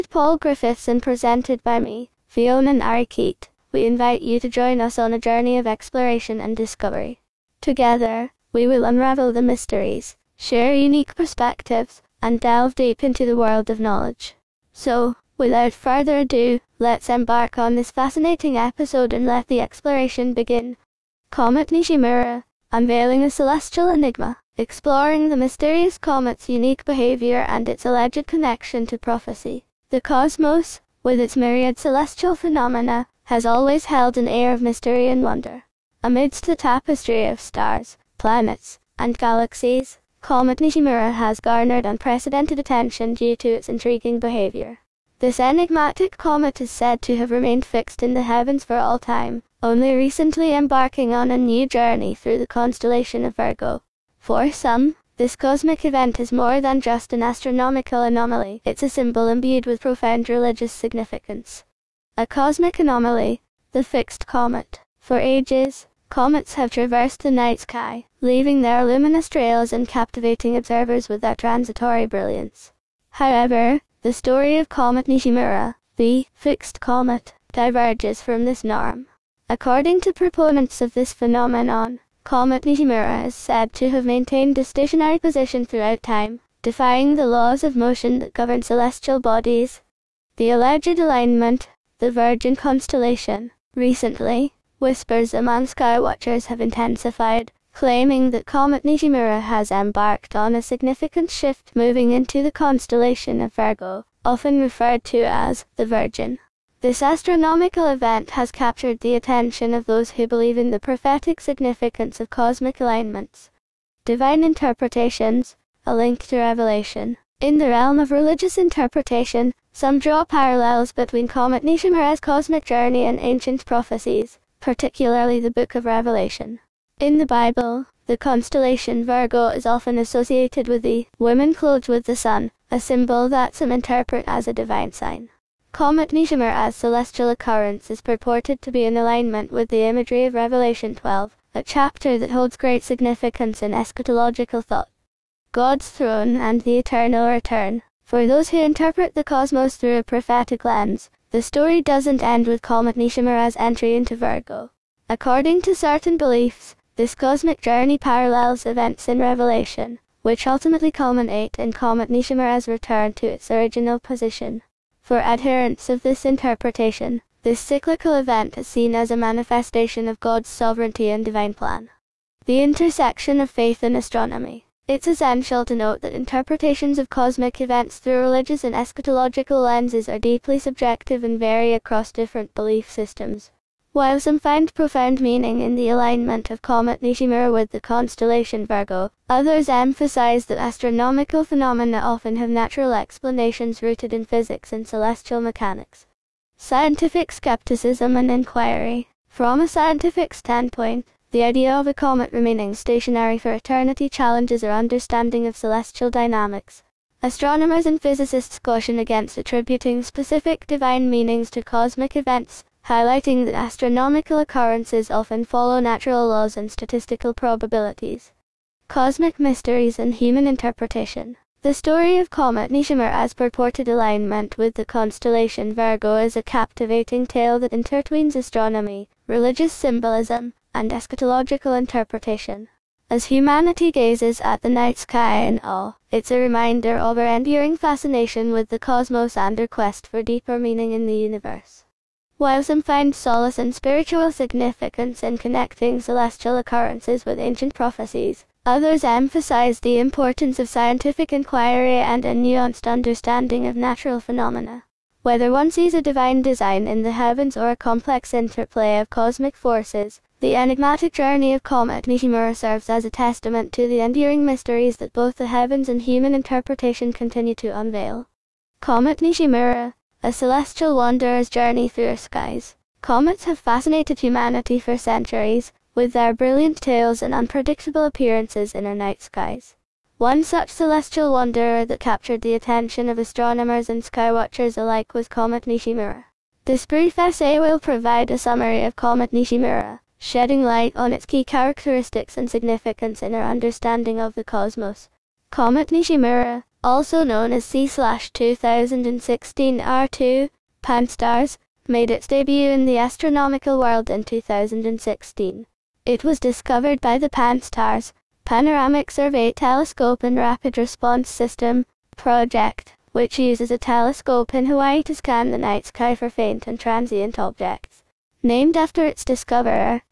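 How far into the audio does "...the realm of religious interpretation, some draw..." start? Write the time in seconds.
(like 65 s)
117 s.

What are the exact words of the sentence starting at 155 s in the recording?
According to certain beliefs, this cosmic journey parallels events in Revelation, which ultimately culminate in Comet Nishimura's return to its original position.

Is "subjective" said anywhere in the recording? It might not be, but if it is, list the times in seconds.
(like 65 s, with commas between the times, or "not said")
180 s.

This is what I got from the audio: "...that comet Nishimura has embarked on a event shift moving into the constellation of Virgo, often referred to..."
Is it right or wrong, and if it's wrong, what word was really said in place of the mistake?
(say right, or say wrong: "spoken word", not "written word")
wrong: "significant", not "event".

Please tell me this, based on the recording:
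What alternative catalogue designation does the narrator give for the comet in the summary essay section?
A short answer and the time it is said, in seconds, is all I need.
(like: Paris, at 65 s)
C/2016 R2 Pan-STARRS, at 297 s.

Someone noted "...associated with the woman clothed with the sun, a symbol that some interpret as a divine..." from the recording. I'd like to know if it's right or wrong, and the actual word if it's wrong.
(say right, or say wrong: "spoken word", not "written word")
right.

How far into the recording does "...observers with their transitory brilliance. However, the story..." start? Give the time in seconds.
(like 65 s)
70 s.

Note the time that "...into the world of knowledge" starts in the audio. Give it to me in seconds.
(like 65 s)
13 s.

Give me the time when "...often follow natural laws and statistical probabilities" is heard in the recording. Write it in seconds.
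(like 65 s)
215 s.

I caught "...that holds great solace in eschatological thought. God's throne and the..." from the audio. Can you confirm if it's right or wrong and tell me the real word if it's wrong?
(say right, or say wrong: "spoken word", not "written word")
wrong: "significance", not "solace".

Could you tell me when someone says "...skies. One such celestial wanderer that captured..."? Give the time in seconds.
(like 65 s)
279 s.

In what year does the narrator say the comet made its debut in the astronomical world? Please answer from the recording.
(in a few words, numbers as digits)
2016.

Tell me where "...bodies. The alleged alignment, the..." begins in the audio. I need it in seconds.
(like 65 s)
89 s.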